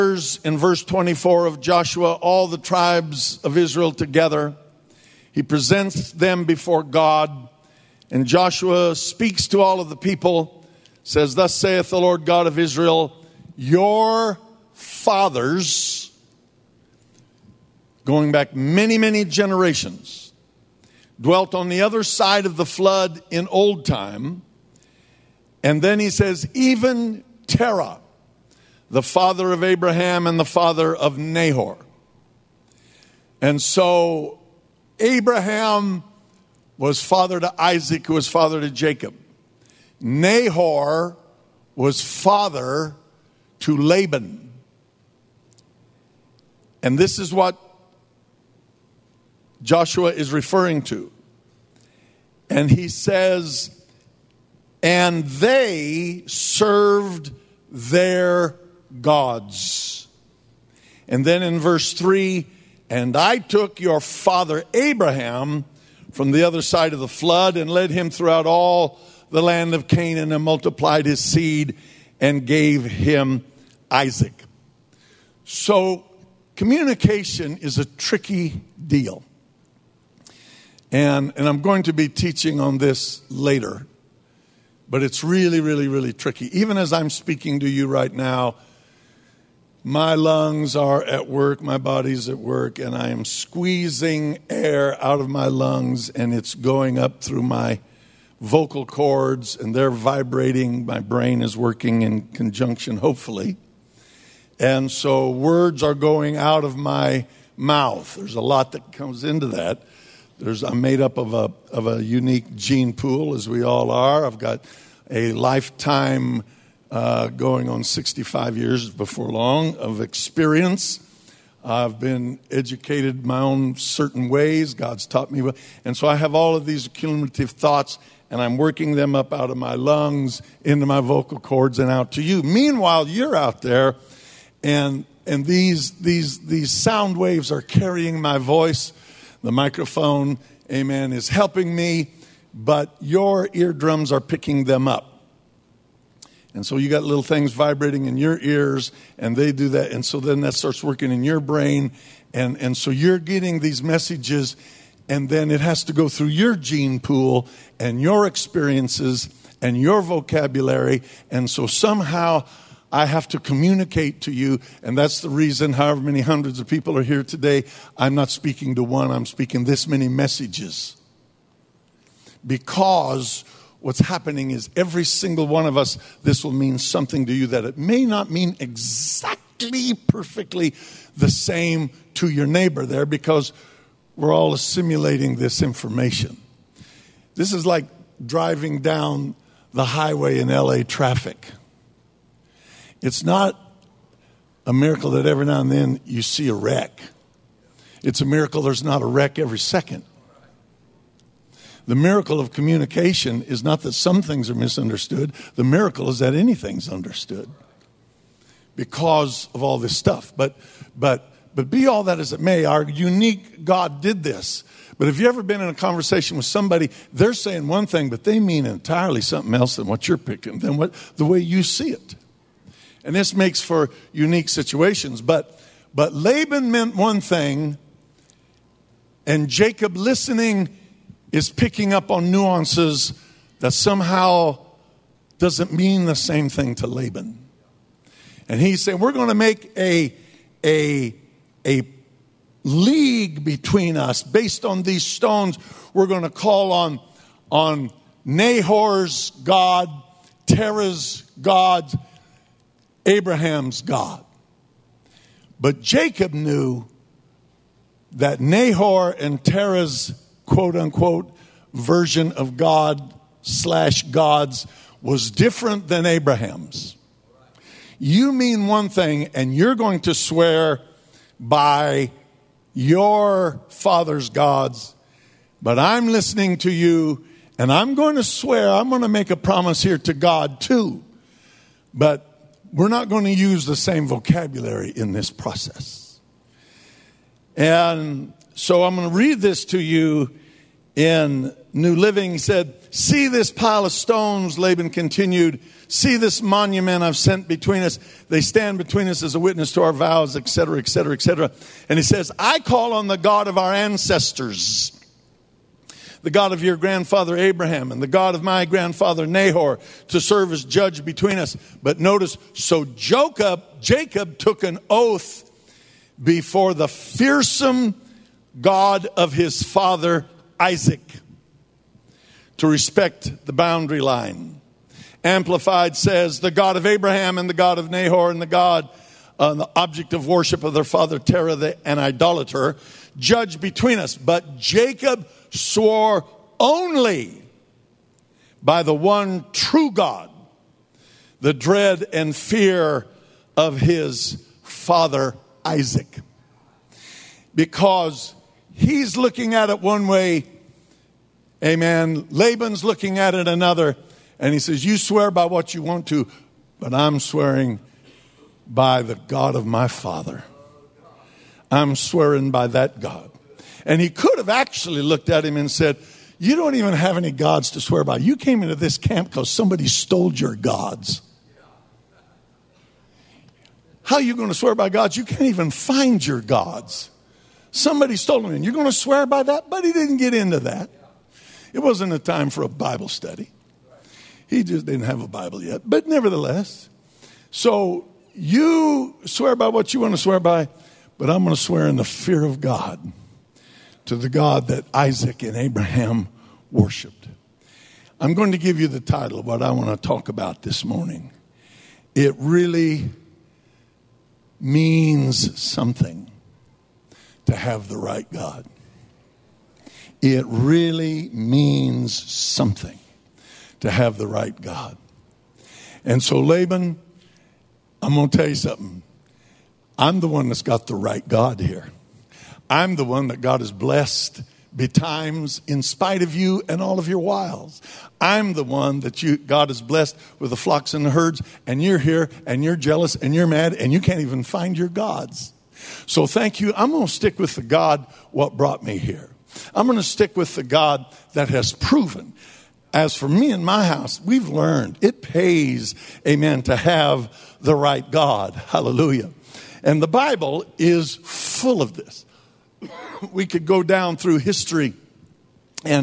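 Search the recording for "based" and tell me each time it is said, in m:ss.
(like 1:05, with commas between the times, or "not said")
4:04.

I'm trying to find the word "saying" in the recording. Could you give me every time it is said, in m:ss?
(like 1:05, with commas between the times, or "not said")
3:37, 3:58.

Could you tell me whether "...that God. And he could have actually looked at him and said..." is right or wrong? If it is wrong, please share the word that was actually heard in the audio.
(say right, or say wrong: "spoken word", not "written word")
right.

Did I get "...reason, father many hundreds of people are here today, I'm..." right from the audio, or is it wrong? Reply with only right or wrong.
wrong.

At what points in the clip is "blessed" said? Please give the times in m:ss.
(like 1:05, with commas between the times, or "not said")
7:03, 7:09.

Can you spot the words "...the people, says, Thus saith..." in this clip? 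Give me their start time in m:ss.
0:09.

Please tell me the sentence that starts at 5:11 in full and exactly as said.
But notice, so Jacob, Jacob took an oath before the fearsome God of his father Isaac to respect the boundary line.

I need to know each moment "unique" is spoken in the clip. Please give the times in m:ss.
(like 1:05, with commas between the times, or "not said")
1:52, 3:32, 3:44.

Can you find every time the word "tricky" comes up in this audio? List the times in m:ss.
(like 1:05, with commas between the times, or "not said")
1:17, 1:26.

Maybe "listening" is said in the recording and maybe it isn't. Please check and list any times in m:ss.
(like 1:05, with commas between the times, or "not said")
3:49, 4:36.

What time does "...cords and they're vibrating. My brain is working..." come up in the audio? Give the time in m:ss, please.
1:38.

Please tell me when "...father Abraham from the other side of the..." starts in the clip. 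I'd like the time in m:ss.
1:03.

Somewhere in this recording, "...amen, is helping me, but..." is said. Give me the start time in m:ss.
2:20.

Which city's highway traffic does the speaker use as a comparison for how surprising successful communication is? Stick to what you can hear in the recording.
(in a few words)
LA.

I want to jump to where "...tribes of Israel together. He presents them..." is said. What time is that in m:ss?
0:02.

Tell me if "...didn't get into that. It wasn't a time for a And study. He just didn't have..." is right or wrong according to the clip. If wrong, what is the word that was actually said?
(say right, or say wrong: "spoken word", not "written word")
wrong: "Bible", not "And".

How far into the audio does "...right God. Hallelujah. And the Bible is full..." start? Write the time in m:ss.
7:27.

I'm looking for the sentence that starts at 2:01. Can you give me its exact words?
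I've been educated my own certain ways.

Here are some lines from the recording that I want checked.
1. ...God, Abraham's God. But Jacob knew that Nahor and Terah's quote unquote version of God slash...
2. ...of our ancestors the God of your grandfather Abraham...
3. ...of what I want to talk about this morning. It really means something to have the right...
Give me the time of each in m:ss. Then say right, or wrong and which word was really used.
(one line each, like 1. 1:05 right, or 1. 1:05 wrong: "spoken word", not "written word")
1. 4:11 right
2. 5:03 right
3. 6:39 right.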